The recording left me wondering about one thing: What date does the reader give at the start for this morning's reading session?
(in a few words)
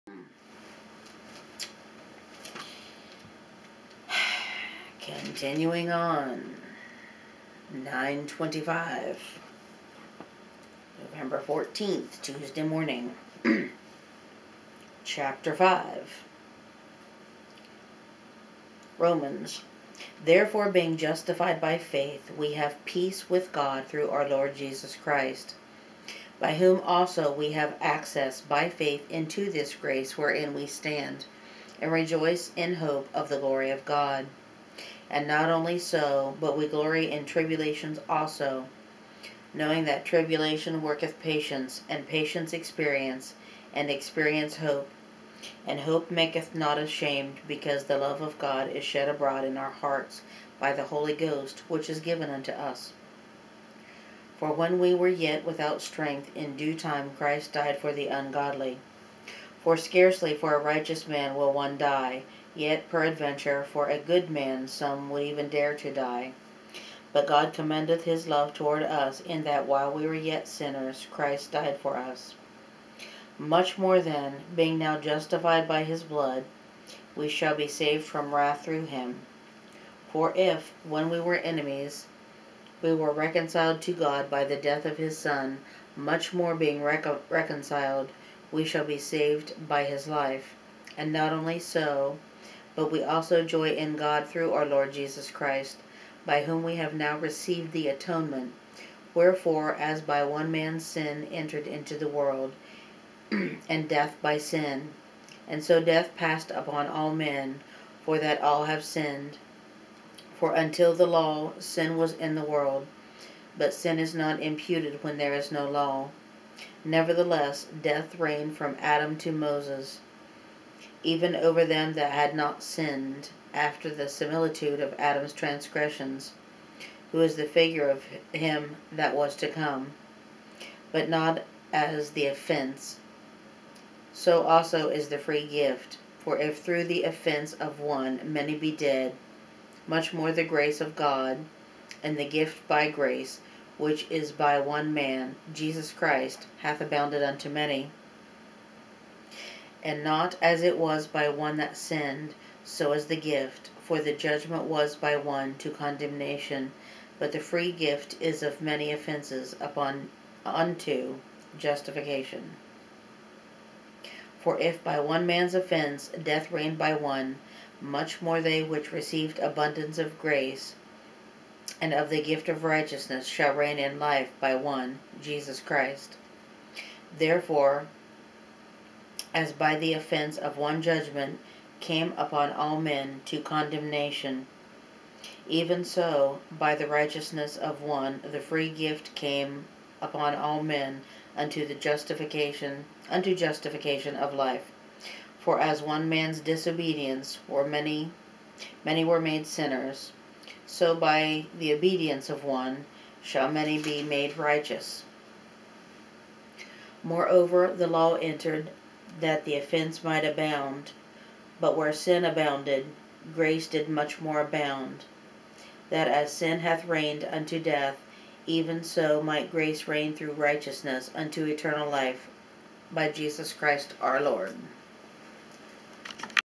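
November 14.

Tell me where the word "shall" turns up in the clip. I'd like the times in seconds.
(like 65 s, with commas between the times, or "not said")
77 s, 88 s, 173 s, 203 s.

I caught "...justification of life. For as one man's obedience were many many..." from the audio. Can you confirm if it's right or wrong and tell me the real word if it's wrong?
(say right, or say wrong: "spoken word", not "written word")
wrong: "disobedience", not "obedience".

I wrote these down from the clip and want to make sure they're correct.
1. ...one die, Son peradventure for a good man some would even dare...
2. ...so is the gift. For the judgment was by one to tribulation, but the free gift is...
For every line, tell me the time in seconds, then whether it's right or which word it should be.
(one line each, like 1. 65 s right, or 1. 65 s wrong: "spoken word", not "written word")
1. 61 s wrong: "Yet", not "Son"
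2. 152 s wrong: "condemnation", not "tribulation".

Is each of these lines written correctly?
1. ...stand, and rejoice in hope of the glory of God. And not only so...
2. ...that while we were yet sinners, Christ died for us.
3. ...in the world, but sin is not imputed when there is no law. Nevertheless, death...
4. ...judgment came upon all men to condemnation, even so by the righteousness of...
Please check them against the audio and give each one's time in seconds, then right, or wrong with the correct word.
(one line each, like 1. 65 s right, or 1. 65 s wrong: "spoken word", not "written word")
1. 30 s right
2. 69 s right
3. 112 s right
4. 180 s right.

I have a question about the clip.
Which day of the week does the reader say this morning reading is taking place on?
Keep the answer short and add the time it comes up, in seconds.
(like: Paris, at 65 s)
Tuesday, at 12 s.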